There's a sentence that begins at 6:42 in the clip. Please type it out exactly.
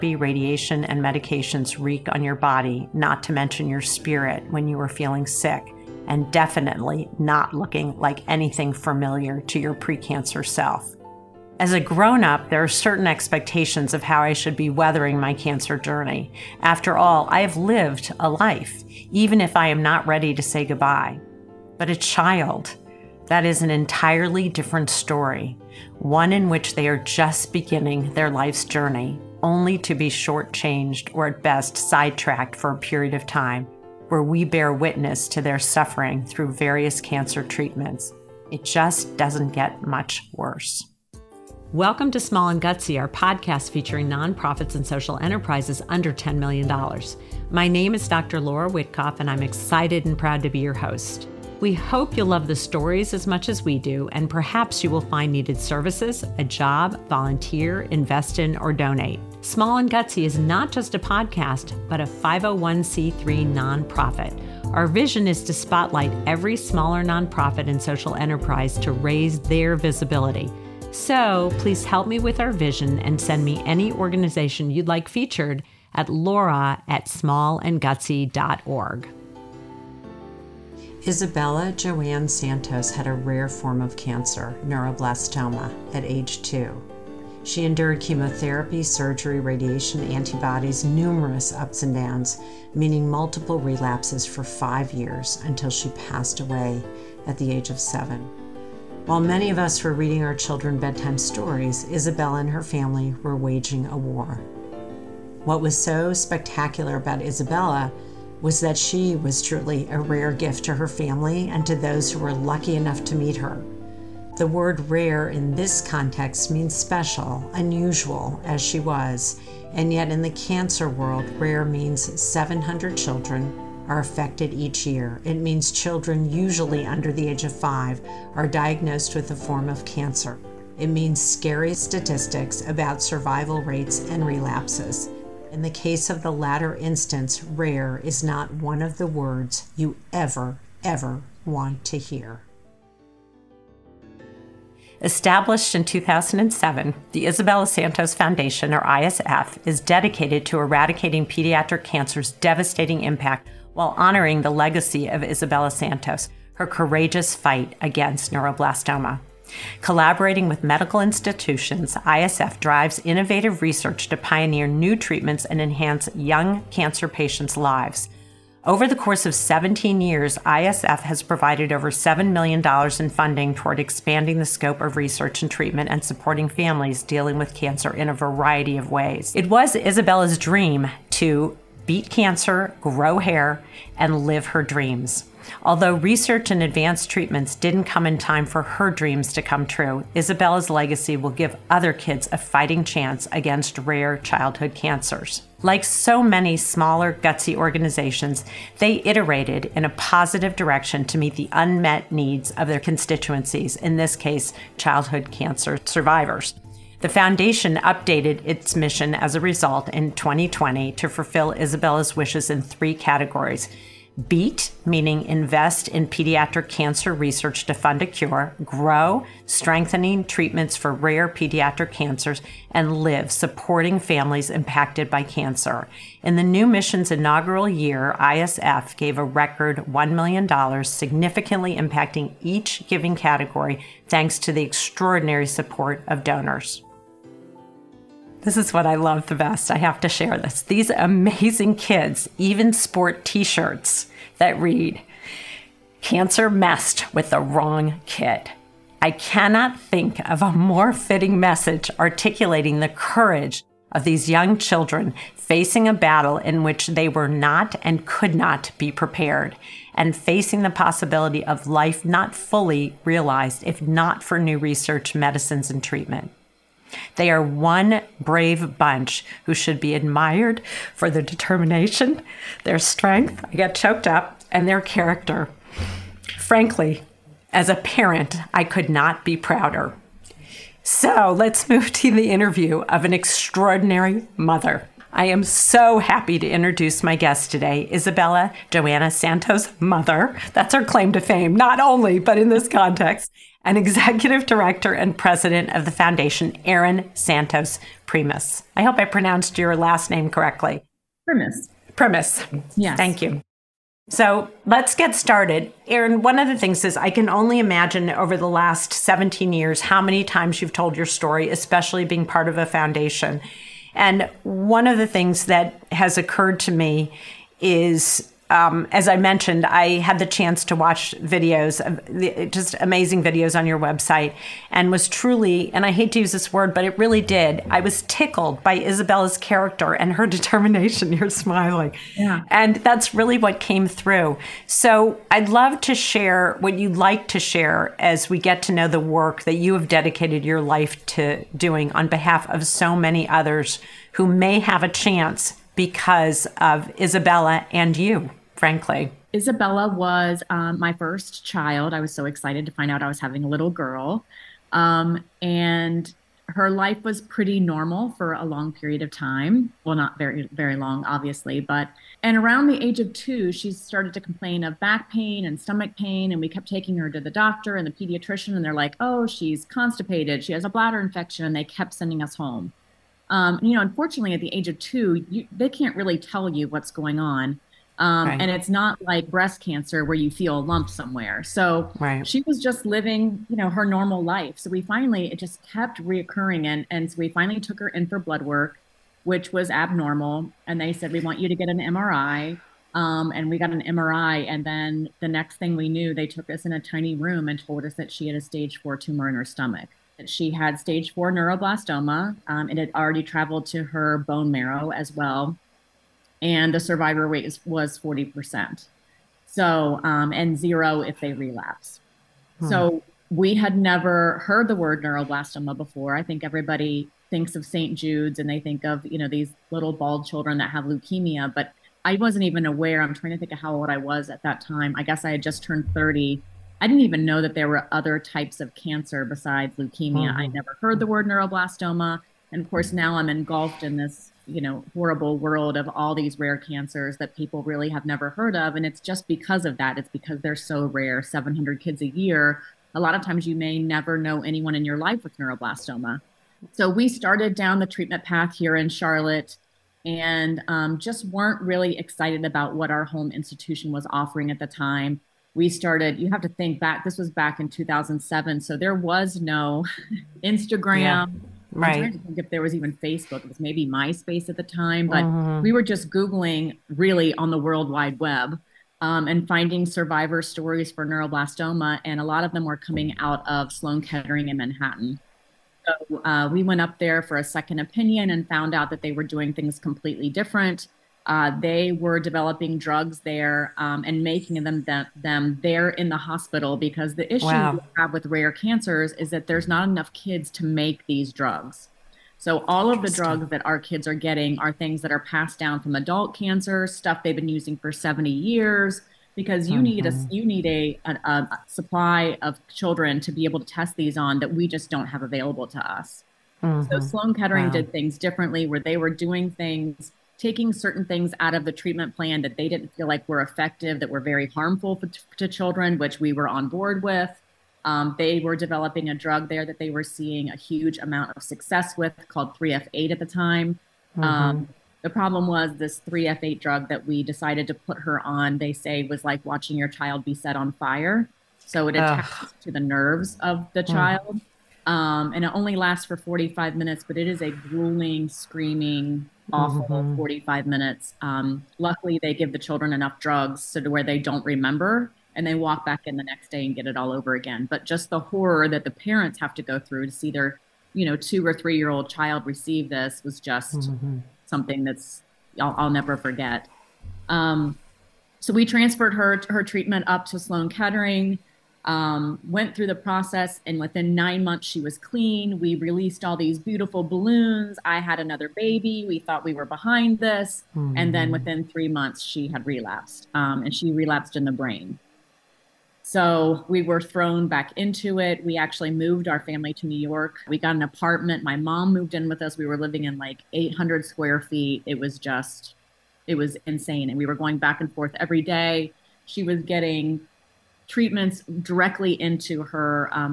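Um, it had already traveled to her bone marrow as well and the survivor rate is, was 40%.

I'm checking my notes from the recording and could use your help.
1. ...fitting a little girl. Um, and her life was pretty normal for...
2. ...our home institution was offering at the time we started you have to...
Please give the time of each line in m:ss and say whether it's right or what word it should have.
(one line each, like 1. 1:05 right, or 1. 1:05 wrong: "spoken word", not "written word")
1. 5:53 wrong: "having", not "fitting"
2. 7:32 right.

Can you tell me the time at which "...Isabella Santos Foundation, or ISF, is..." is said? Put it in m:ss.
2:27.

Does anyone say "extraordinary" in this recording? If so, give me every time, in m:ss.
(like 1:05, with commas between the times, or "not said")
3:54, 4:43.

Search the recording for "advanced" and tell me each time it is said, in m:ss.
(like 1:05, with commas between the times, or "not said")
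3:06.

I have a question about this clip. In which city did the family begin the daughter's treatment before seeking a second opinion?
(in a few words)
Charlotte.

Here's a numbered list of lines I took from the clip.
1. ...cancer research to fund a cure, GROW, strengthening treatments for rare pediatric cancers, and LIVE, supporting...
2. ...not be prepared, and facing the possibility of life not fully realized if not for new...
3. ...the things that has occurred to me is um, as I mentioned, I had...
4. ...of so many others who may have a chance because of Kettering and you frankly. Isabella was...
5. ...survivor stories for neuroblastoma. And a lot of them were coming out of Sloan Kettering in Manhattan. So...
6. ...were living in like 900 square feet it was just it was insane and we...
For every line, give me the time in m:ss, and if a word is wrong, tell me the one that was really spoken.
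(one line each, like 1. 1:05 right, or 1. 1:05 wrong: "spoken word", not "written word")
1. 3:36 right
2. 4:18 right
3. 5:14 right
4. 5:42 wrong: "Isabella", not "Kettering"
5. 7:49 right
6. 9:42 wrong: "800", not "900".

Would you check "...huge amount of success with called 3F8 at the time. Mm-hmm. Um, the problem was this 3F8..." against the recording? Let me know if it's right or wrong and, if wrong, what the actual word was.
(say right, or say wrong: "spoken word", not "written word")
right.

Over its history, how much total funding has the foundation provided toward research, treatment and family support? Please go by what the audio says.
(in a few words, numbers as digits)
over $7 million.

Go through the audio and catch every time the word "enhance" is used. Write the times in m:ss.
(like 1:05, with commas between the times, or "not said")
2:45.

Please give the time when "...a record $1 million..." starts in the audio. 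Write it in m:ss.
3:49.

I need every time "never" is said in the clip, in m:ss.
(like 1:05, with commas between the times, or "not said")
6:53, 7:10, 7:18, 7:23, 9:15.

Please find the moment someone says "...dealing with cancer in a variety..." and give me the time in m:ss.
2:57.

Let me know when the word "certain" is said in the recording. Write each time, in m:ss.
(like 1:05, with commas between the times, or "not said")
0:12, 8:30.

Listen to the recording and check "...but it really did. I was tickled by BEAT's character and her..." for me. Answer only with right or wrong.
wrong.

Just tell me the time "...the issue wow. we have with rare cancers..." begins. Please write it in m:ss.
8:07.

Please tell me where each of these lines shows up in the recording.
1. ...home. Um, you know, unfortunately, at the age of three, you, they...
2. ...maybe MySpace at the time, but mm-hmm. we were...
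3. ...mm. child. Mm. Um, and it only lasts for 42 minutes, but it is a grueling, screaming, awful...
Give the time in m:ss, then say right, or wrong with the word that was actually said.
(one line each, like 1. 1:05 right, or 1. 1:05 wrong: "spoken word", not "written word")
1. 6:12 wrong: "two", not "three"
2. 7:43 right
3. 8:53 wrong: "45", not "42".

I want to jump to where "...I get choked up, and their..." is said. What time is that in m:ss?
4:33.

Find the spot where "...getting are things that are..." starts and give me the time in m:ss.
8:14.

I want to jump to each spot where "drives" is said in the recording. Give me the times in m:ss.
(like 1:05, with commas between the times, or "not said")
2:42.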